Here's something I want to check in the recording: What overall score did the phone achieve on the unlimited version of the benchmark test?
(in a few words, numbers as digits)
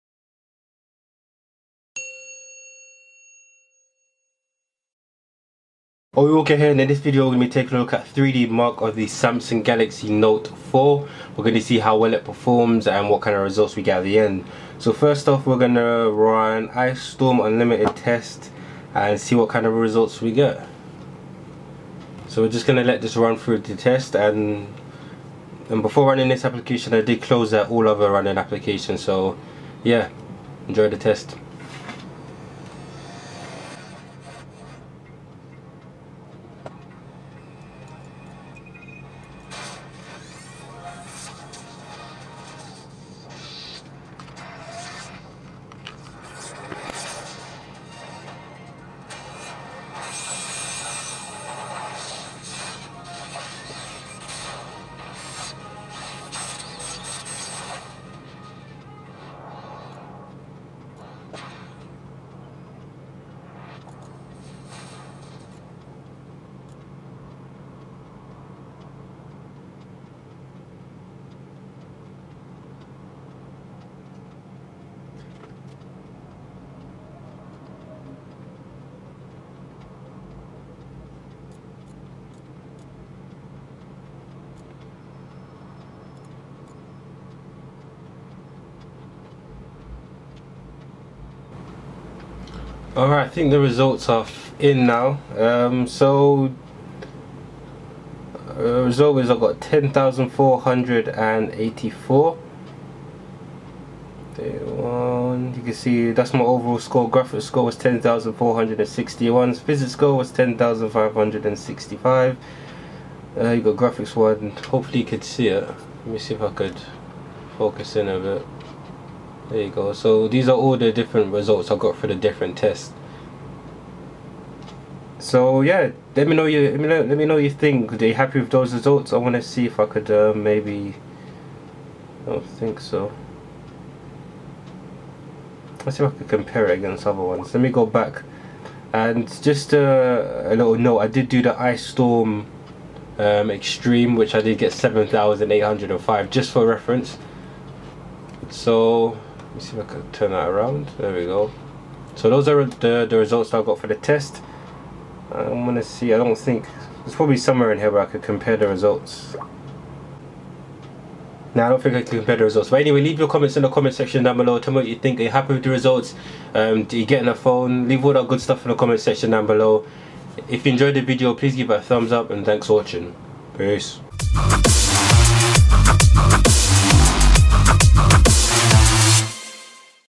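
10,484.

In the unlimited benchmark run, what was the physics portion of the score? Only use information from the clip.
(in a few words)
10,565.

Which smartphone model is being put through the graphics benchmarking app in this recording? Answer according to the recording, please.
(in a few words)
Samsung Galaxy Note 4.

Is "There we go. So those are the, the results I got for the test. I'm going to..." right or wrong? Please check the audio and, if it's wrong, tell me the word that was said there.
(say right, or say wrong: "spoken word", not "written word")
right.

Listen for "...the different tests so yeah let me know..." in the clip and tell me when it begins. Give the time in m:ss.
2:02.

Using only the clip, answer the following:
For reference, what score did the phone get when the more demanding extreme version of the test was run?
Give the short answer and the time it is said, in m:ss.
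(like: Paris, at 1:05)
7,805, at 2:24.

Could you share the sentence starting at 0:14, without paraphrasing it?
So first off we're going to run Ice Storm Unlimited test and see what kind of results we get.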